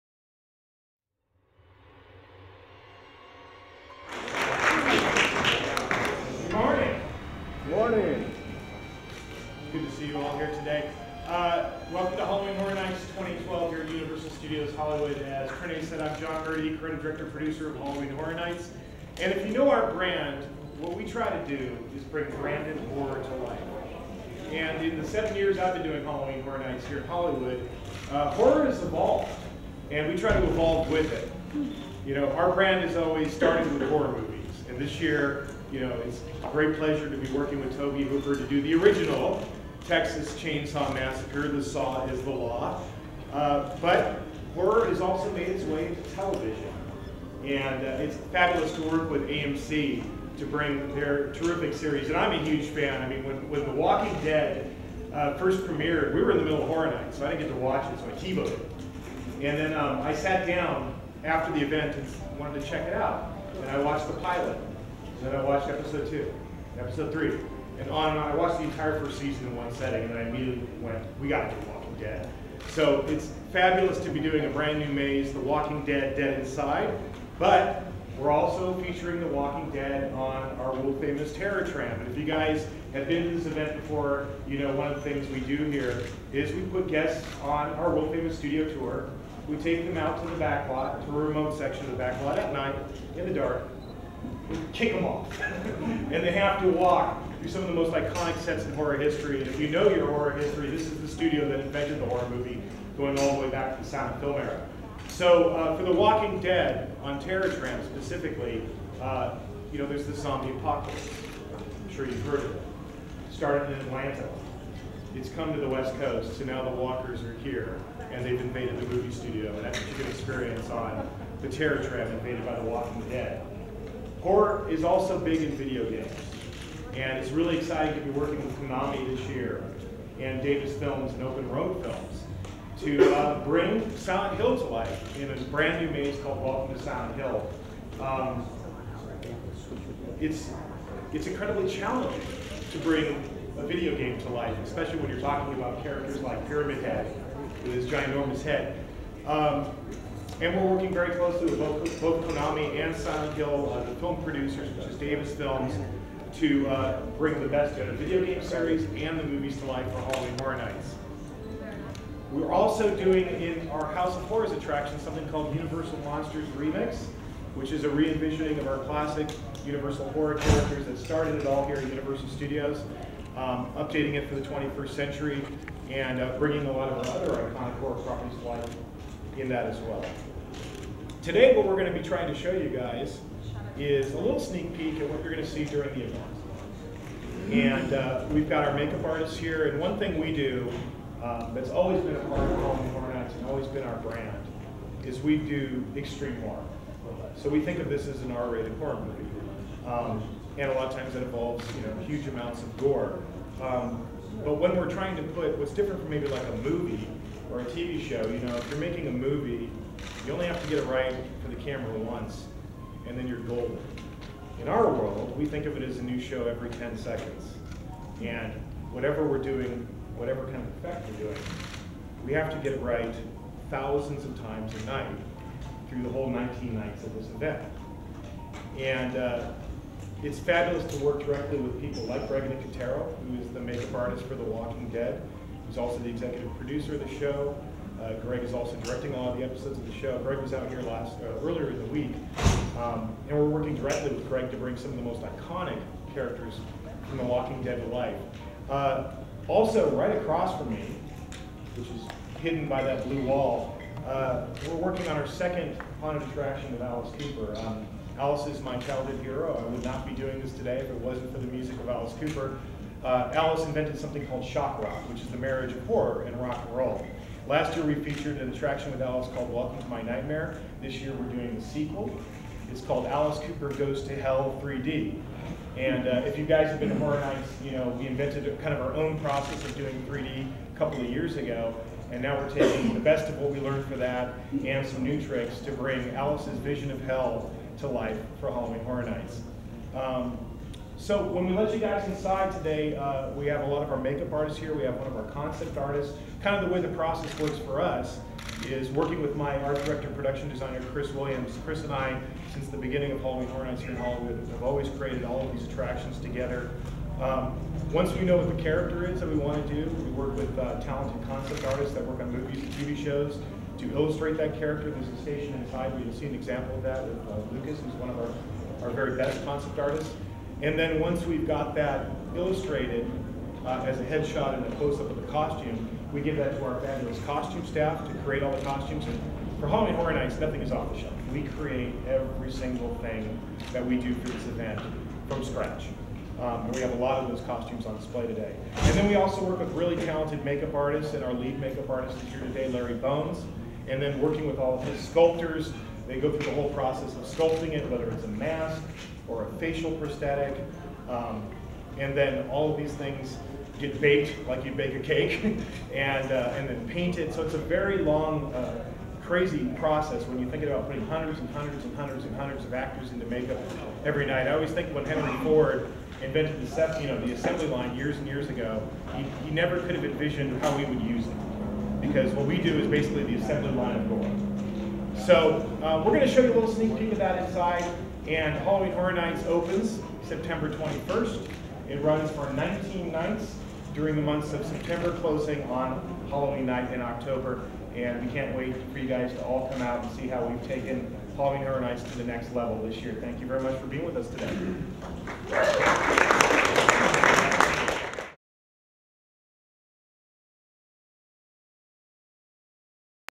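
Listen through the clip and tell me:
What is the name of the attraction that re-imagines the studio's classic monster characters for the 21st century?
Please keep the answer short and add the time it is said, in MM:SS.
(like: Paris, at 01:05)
Universal Monsters Remix, at 02:45.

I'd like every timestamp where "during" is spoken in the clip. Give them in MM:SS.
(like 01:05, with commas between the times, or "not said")
03:05, 06:23.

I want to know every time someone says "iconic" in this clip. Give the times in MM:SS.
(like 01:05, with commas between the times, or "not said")
01:37, 02:57, 04:05.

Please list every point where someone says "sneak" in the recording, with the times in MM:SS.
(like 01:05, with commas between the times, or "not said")
03:04, 06:16.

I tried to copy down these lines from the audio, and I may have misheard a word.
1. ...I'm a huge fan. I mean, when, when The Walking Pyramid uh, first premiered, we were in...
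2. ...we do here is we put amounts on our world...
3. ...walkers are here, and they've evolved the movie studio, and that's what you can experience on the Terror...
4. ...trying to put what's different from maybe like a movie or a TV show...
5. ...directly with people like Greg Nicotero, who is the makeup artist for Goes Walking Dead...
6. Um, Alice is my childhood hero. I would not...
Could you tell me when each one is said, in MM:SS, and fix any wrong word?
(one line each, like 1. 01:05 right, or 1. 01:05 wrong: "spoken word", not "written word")
1. 00:52 wrong: "Dead", not "Pyramid"
2. 01:25 wrong: "guests", not "amounts"
3. 01:56 wrong: "invaded", not "evolved"
4. 03:24 right
5. 03:51 wrong: "The", not "Goes"
6. 04:17 right.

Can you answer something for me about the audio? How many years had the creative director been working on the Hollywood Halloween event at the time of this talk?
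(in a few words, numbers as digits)
7.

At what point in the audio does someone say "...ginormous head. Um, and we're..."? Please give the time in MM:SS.
02:27.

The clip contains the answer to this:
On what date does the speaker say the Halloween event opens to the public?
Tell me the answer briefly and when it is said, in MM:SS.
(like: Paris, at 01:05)
September 21st, at 06:20.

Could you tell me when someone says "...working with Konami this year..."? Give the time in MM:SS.
02:08.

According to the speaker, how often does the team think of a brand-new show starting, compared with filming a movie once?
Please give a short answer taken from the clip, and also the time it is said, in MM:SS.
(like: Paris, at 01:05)
Every 10 seconds, at 03:36.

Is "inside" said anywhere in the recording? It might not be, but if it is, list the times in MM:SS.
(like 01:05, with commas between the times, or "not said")
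01:16, 04:52, 05:15, 06:17.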